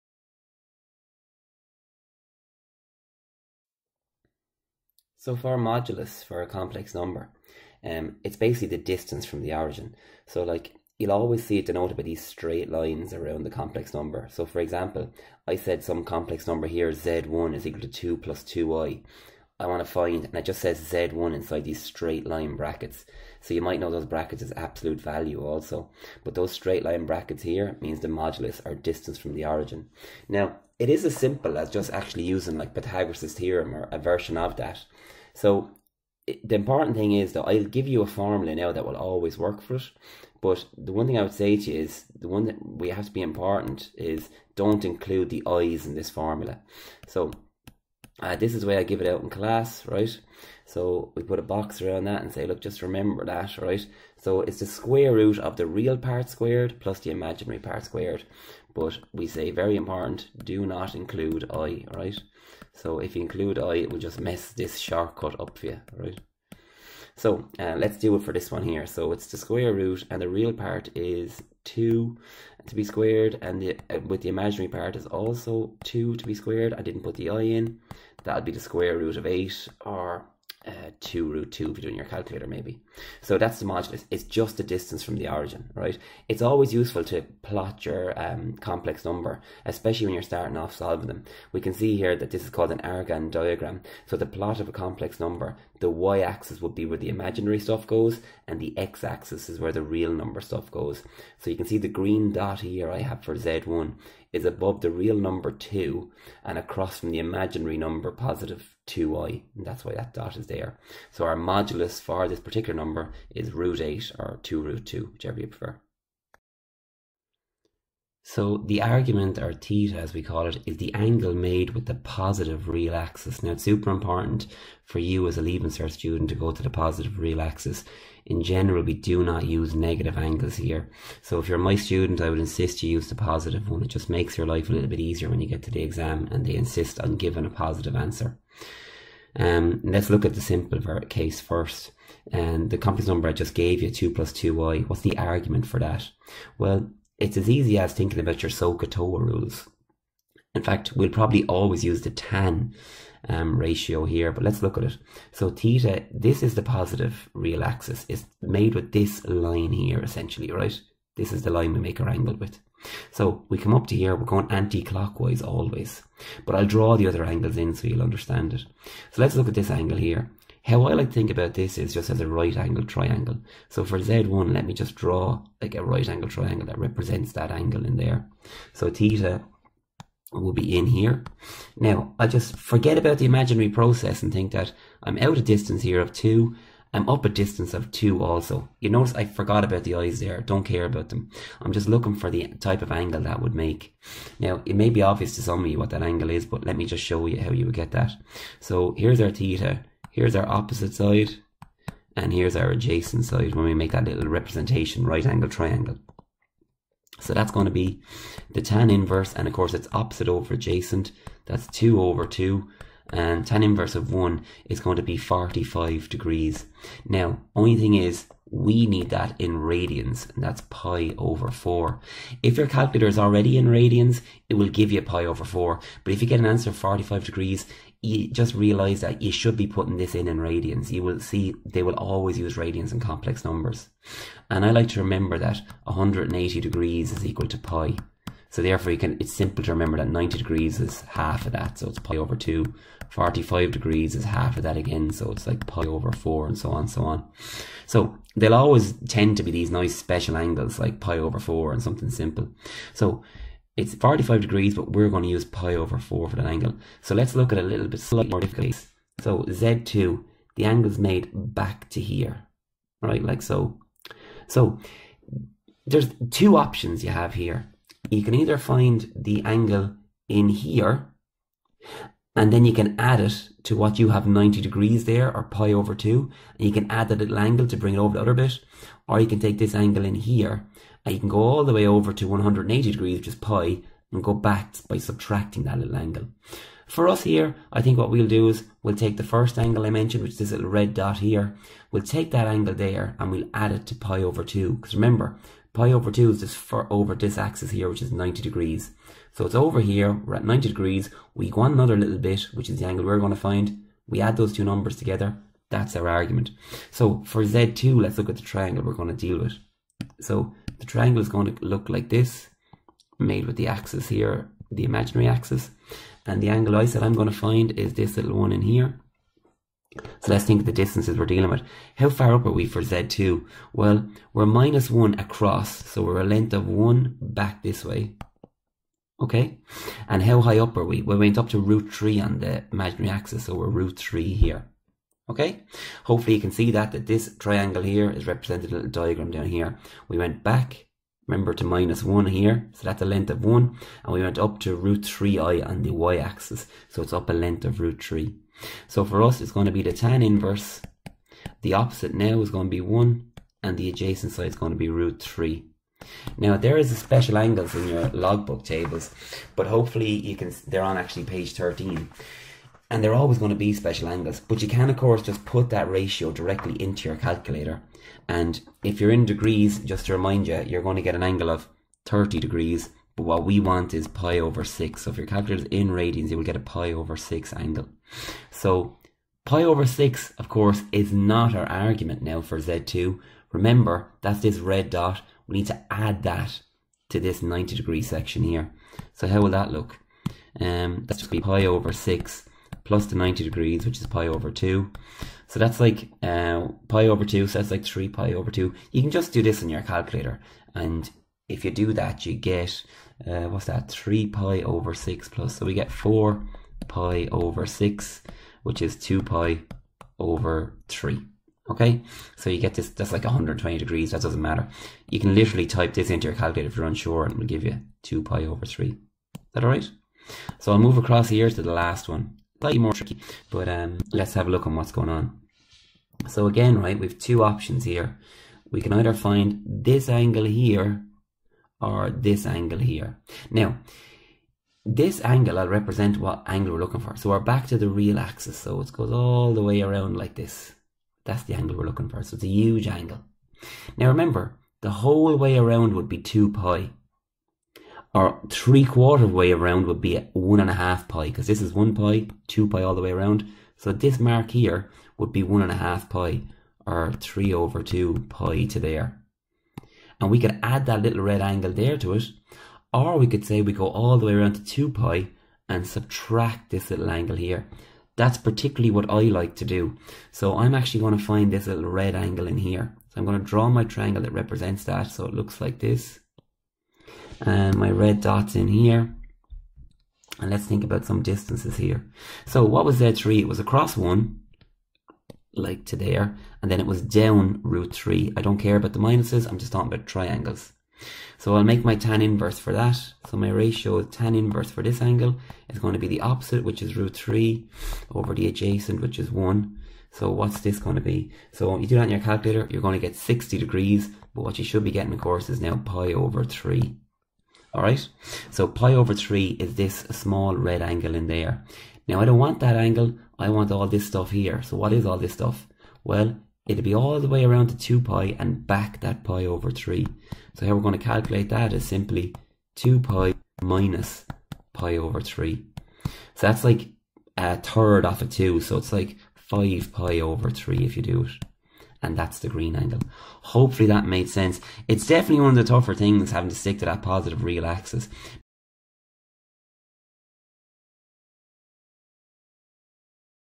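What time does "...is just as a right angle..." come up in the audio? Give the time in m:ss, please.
2:51.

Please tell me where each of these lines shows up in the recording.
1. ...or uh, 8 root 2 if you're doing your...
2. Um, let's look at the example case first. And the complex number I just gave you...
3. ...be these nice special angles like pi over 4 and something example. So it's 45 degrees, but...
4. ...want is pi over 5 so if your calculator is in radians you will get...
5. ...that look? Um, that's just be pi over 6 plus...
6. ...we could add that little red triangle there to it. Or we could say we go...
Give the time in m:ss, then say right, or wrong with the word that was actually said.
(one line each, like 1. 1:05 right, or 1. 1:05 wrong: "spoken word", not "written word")
1. 1:19 wrong: "2", not "8"
2. 2:19 wrong: "simple", not "example"
3. 4:09 wrong: "simple", not "example"
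4. 6:13 wrong: "6", not "5"
5. 6:29 right
6. 7:40 wrong: "angle", not "triangle".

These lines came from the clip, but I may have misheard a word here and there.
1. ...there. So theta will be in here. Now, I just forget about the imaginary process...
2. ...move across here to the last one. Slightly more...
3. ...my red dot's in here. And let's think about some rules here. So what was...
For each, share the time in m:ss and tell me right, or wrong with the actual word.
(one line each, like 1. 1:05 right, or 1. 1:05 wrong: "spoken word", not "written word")
1. 2:57 right
2. 7:00 right
3. 7:57 wrong: "distances", not "rules".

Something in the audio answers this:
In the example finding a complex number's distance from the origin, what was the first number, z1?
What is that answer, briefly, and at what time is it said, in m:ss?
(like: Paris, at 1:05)
2 + 2i, at 0:17.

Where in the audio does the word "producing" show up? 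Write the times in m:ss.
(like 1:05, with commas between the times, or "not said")
not said.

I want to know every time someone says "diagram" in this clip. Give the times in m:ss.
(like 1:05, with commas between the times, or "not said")
1:33, 5:38.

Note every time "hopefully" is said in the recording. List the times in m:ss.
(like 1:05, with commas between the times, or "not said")
5:36, 5:59, 8:53.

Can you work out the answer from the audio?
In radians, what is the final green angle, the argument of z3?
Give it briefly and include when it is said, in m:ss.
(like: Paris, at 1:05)
5π/3, at 8:49.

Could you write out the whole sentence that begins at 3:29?
And of course, it's opposite over adjacent.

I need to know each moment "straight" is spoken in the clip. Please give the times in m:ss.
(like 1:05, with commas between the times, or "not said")
0:12, 0:21, 0:26.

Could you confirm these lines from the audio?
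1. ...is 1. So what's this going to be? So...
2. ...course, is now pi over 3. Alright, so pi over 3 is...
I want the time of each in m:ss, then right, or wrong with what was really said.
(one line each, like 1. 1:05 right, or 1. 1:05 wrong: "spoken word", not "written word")
1. 8:19 right
2. 8:25 right.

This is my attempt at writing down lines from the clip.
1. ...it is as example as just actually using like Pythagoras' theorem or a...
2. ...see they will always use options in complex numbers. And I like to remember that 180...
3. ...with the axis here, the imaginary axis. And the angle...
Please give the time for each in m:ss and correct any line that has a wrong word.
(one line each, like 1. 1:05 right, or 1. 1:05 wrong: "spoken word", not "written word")
1. 0:30 wrong: "simple", not "example"
2. 3:51 wrong: "radians", not "options"
3. 5:13 right.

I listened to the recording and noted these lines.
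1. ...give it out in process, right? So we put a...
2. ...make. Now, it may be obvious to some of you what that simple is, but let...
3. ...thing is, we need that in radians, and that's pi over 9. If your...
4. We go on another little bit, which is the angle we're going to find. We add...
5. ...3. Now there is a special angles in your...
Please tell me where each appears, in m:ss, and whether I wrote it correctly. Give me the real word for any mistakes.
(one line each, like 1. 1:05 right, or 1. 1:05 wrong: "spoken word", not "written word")
1. 0:48 wrong: "class", not "process"
2. 3:13 wrong: "angle", not "simple"
3. 3:37 wrong: "4", not "9"
4. 5:01 right
5. 5:55 right.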